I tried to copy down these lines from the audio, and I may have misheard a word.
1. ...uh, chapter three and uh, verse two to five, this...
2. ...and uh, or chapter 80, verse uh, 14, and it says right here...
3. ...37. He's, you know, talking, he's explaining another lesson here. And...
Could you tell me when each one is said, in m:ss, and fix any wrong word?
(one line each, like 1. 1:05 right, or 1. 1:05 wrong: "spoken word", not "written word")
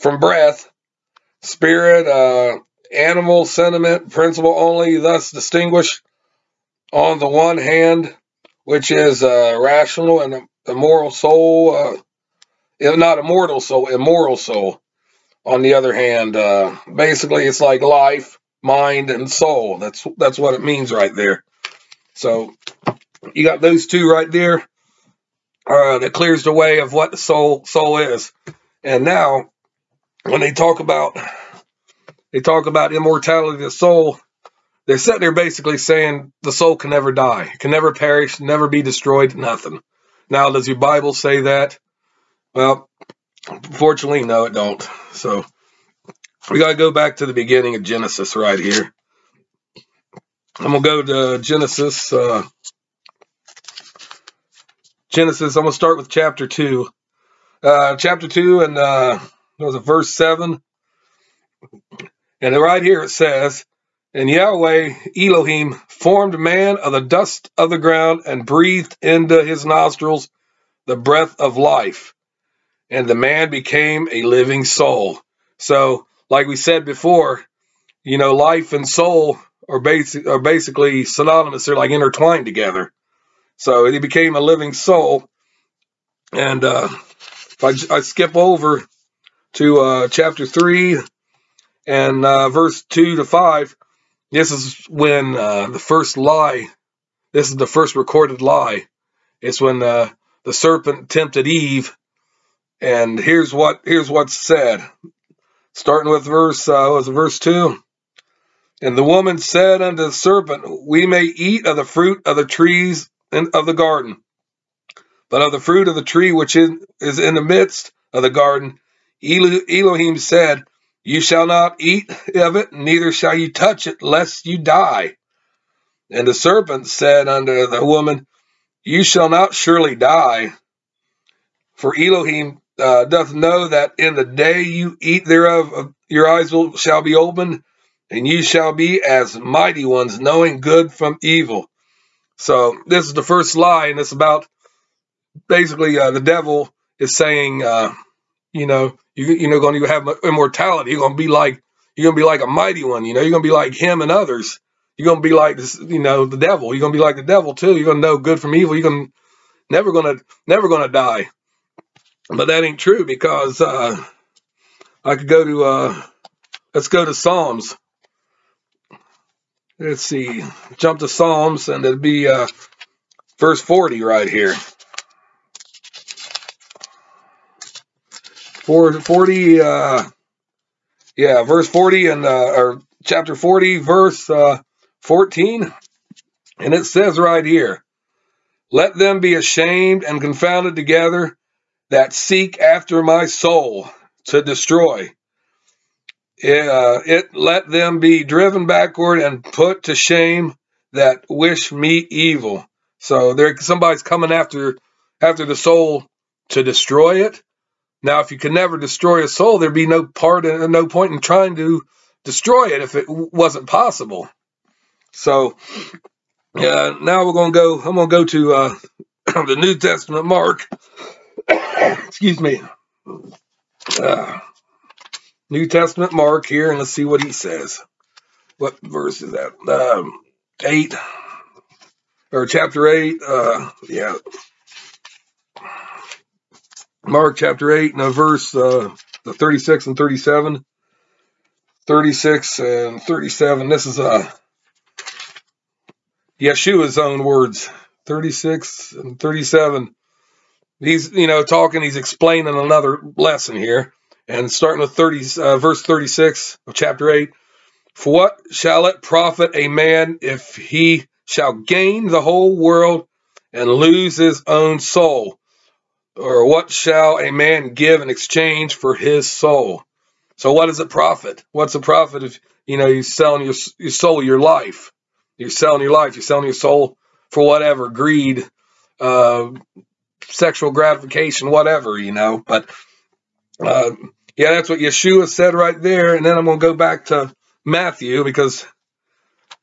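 1. 1:29 right
2. 3:02 wrong: "40", not "80"
3. 4:09 right.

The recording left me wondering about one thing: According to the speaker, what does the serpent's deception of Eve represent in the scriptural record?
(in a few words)
The first recorded lie.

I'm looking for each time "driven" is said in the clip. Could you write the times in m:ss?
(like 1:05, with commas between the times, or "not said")
3:18.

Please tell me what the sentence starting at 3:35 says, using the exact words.
So, uh, now we're gonna go.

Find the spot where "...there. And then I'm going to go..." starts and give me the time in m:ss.
4:45.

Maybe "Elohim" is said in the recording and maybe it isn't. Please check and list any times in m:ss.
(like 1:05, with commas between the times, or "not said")
1:05, 1:59, 2:11.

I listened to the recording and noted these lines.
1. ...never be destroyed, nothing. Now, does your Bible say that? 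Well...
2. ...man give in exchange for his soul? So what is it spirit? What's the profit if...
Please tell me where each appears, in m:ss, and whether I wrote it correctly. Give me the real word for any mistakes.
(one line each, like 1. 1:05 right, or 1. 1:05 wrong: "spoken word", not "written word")
1. 0:38 right
2. 4:27 wrong: "profit", not "spirit".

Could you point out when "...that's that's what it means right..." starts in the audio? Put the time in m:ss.
0:19.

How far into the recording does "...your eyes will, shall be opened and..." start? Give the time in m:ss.
2:16.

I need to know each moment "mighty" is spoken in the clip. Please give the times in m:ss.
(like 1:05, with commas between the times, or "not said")
2:19, 2:32.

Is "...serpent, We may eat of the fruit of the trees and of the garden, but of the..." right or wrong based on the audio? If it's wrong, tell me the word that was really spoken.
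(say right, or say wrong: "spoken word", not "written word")
right.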